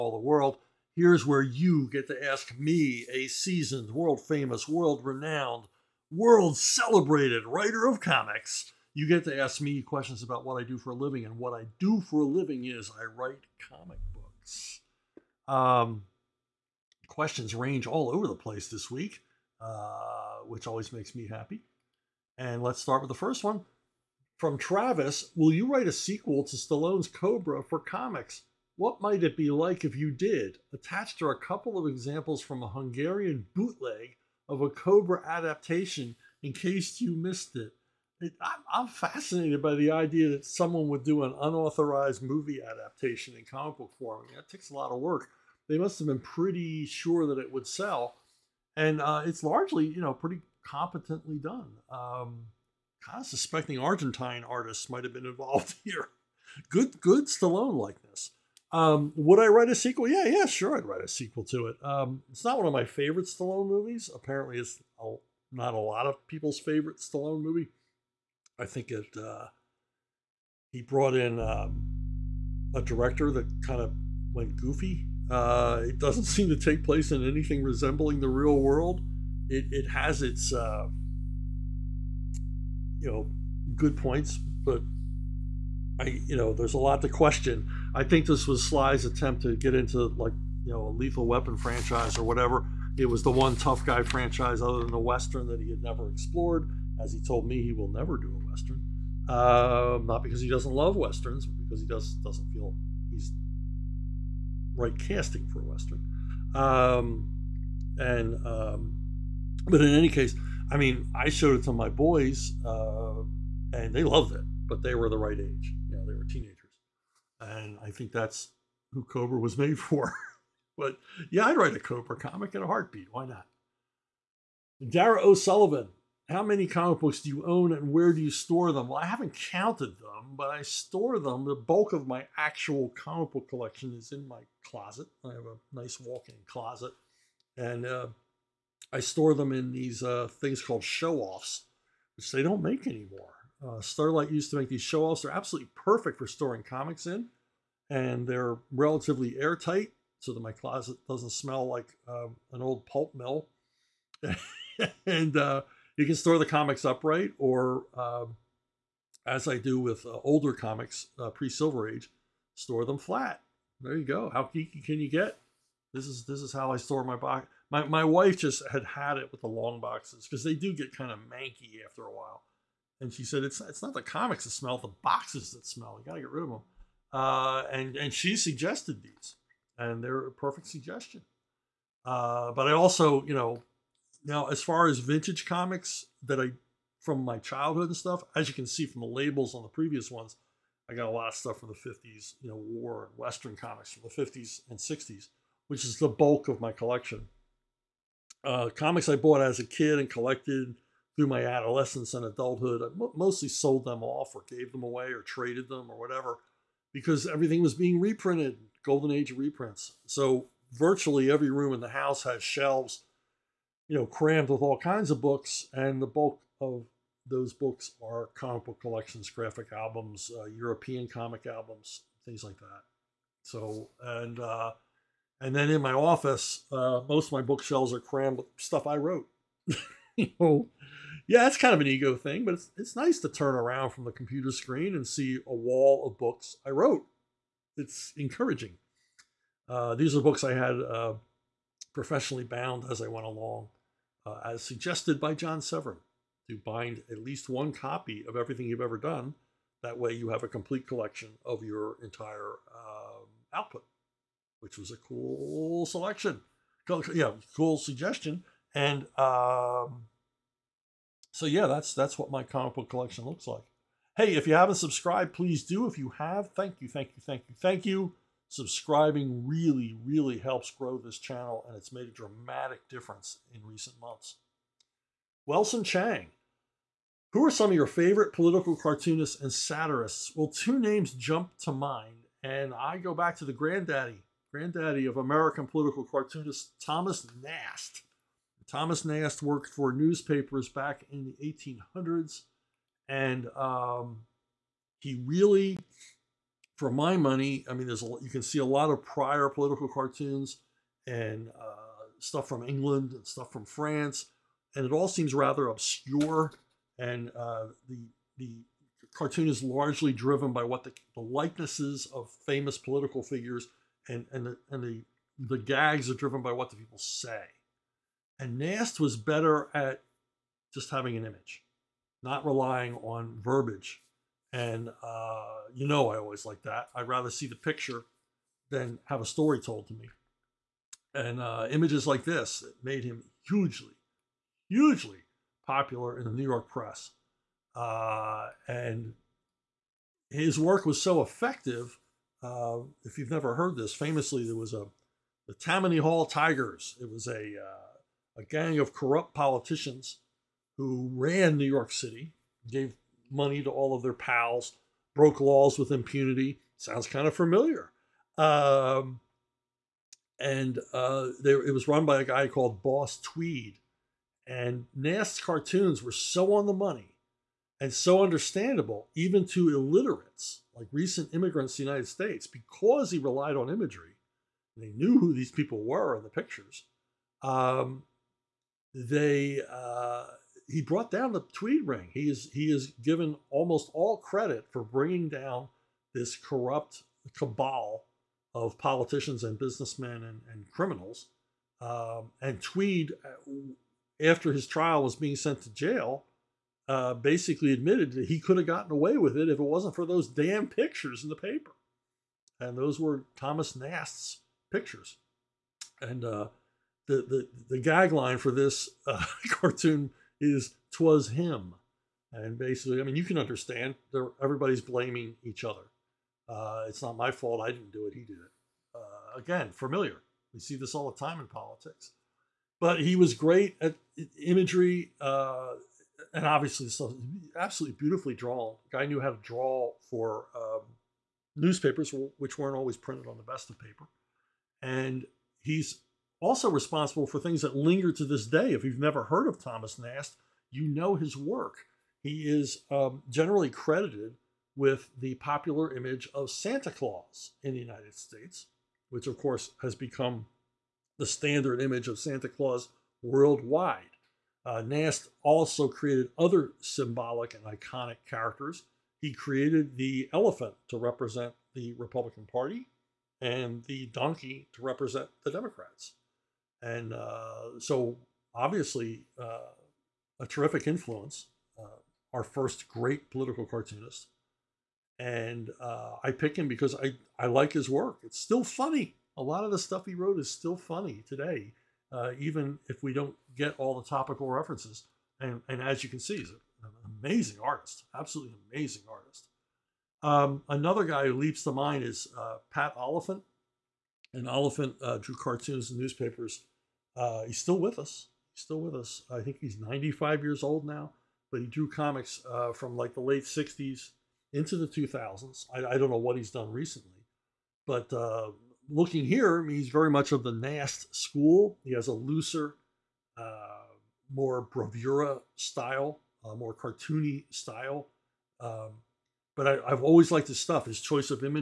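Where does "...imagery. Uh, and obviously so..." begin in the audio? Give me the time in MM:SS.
07:04.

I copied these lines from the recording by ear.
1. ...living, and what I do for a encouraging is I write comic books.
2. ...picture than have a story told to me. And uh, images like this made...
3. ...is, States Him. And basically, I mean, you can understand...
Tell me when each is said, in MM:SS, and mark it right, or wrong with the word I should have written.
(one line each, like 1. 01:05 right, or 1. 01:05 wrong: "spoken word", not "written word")
1. 00:10 wrong: "living", not "encouraging"
2. 05:27 right
3. 06:50 wrong: "Twas", not "States".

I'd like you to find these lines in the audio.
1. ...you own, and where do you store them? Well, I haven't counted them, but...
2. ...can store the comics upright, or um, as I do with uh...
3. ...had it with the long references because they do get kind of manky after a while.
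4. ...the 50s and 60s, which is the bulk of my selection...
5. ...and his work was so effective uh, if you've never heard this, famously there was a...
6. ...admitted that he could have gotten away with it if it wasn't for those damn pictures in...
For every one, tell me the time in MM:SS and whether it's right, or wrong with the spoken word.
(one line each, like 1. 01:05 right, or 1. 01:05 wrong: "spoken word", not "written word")
1. 02:07 right
2. 02:36 right
3. 02:48 wrong: "boxes", not "references"
4. 03:14 wrong: "collection", not "selection"
5. 05:38 right
6. 06:37 right.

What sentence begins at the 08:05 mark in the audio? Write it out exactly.
And, and as you can see, he's an amazing artist, absolutely amazing artist.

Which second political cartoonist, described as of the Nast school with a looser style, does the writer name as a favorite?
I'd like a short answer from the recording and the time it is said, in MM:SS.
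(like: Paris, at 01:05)
Pat Oliphant, at 08:12.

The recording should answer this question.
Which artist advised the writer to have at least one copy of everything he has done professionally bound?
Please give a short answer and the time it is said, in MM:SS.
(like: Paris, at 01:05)
John Severin, at 04:05.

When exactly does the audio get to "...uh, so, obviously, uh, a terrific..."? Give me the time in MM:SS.
07:47.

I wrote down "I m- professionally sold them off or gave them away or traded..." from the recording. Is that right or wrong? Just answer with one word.
wrong.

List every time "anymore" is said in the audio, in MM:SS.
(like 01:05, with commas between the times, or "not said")
02:22.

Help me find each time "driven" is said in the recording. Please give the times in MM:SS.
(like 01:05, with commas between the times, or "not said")
05:10, 05:16.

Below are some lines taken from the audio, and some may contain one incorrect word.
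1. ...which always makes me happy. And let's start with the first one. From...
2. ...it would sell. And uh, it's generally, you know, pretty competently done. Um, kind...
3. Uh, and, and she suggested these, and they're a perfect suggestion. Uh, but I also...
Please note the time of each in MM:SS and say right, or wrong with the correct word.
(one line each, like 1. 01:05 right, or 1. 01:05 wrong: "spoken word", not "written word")
1. 00:20 right
2. 00:47 wrong: "largely", not "generally"
3. 02:57 right.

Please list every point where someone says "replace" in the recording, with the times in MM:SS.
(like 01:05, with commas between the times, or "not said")
not said.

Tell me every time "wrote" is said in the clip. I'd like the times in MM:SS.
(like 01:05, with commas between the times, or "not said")
03:48, 03:56, 08:00.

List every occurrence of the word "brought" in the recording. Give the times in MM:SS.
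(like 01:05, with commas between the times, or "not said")
01:10, 06:20.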